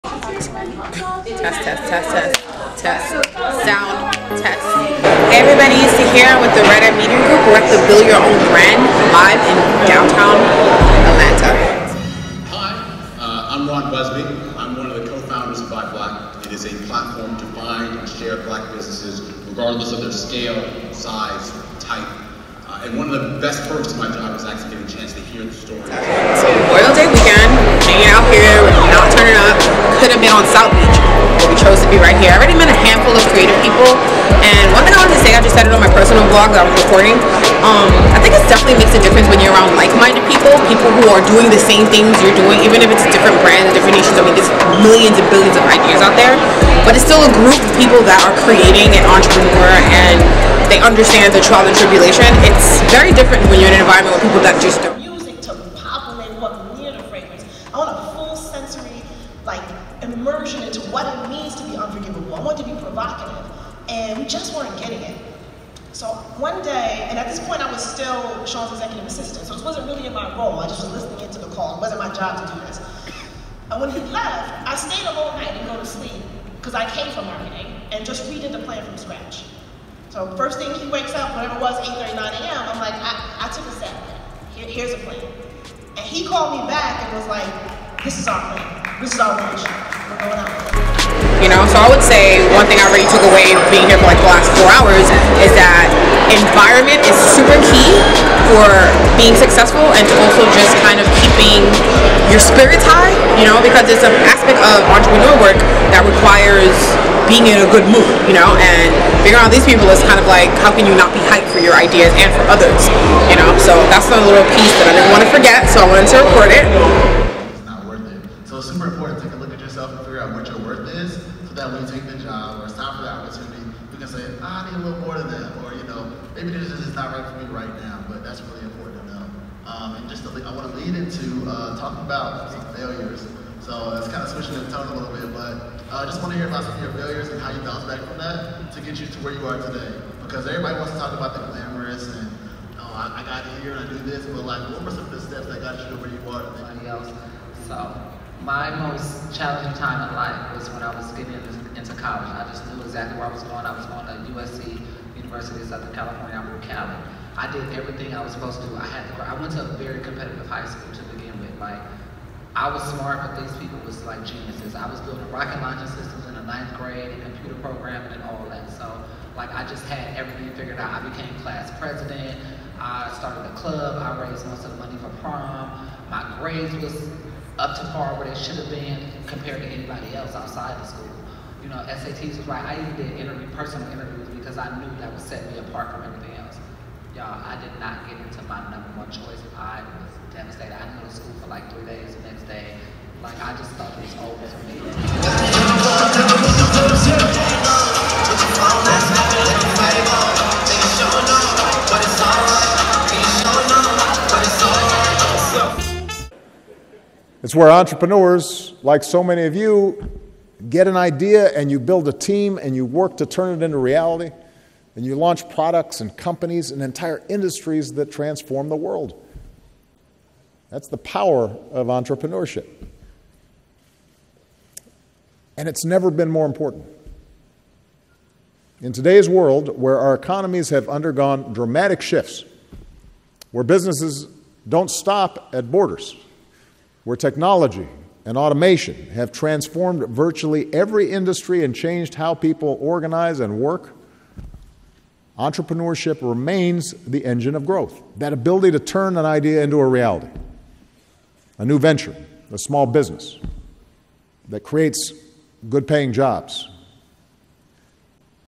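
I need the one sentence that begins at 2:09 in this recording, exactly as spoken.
Um, and just to, I want to lead into uh, talking about some failures.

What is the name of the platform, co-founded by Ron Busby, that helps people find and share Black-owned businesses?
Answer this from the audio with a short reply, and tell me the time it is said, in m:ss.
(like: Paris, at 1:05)
Buy Black, at 0:15.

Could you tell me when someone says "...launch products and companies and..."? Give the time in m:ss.
3:35.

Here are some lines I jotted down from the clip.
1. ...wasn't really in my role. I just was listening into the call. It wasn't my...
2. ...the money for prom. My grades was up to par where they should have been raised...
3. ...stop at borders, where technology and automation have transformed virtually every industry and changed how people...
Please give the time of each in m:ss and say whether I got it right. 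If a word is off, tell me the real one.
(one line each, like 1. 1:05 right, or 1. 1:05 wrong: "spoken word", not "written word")
1. 1:09 right
2. 2:54 wrong: "compared", not "raised"
3. 3:54 right.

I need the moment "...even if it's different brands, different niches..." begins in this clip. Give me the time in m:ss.
0:42.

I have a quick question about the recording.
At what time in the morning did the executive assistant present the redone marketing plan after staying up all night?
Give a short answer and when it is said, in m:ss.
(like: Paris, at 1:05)
8:39 a.m., at 1:21.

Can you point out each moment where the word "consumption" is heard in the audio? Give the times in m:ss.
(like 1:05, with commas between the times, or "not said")
not said.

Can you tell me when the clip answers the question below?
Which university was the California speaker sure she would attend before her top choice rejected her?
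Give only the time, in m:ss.
2:35.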